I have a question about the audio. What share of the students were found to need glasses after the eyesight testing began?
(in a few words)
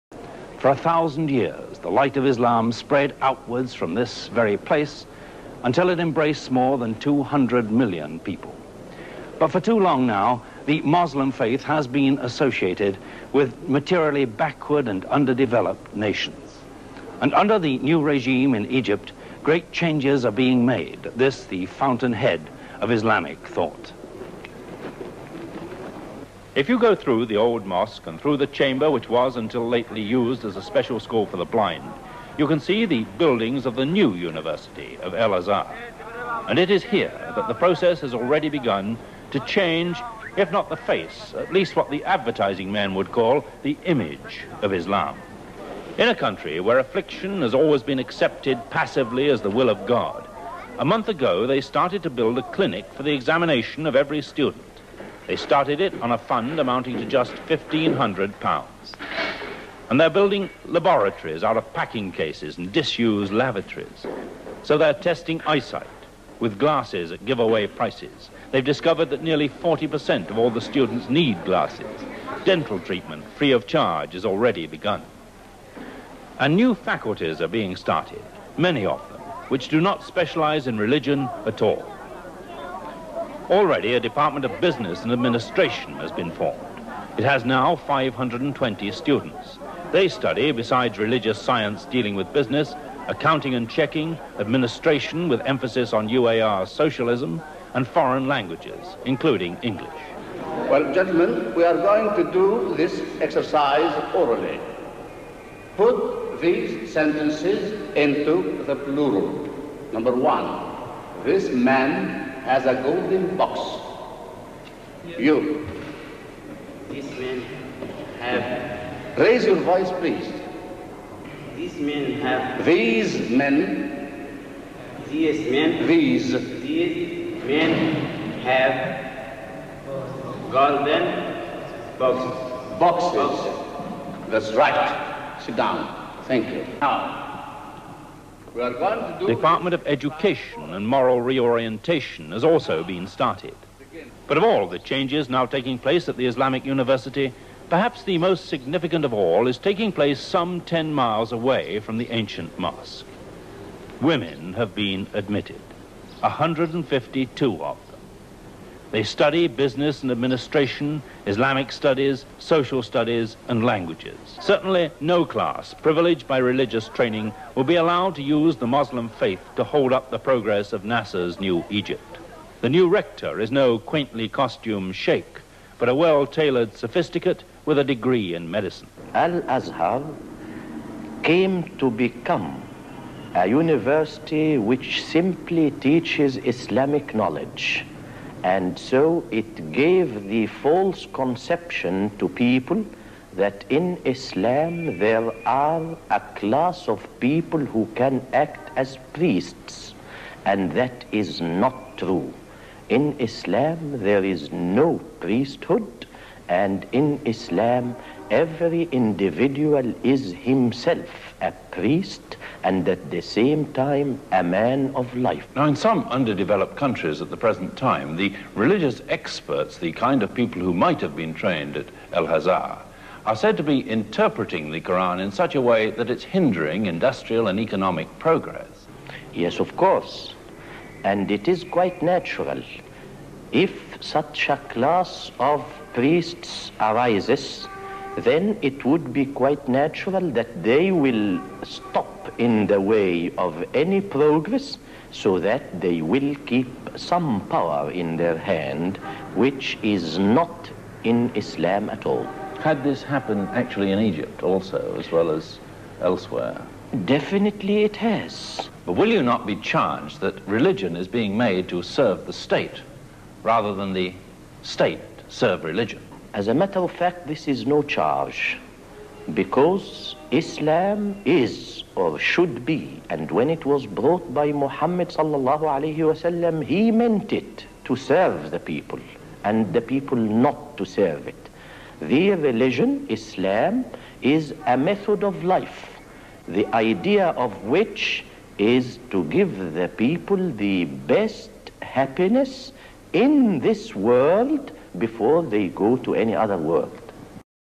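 40%.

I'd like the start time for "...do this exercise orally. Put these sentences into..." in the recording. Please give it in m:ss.
1:42.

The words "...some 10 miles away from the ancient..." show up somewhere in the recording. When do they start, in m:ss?
2:30.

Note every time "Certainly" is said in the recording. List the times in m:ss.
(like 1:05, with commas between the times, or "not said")
2:44.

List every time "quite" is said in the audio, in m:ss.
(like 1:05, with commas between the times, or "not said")
3:51, 3:59.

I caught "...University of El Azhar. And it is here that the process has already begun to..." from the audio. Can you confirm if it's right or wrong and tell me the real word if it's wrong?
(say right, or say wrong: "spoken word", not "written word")
right.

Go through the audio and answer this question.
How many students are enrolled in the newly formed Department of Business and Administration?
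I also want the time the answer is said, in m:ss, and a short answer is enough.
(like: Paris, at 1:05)
520, at 1:27.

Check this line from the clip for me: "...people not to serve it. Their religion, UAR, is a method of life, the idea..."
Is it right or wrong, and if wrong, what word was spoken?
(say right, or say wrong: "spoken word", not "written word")
wrong: "Islam", not "UAR".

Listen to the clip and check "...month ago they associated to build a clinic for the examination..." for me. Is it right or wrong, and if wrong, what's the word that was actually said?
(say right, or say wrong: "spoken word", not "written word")
wrong: "started", not "associated".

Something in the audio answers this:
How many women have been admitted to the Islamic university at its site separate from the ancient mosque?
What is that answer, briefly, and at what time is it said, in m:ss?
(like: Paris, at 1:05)
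152, at 2:36.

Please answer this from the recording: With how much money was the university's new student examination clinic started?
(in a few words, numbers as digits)
£1,500.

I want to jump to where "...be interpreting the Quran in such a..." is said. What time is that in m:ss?
3:43.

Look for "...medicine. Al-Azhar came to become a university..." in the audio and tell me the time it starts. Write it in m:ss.
2:58.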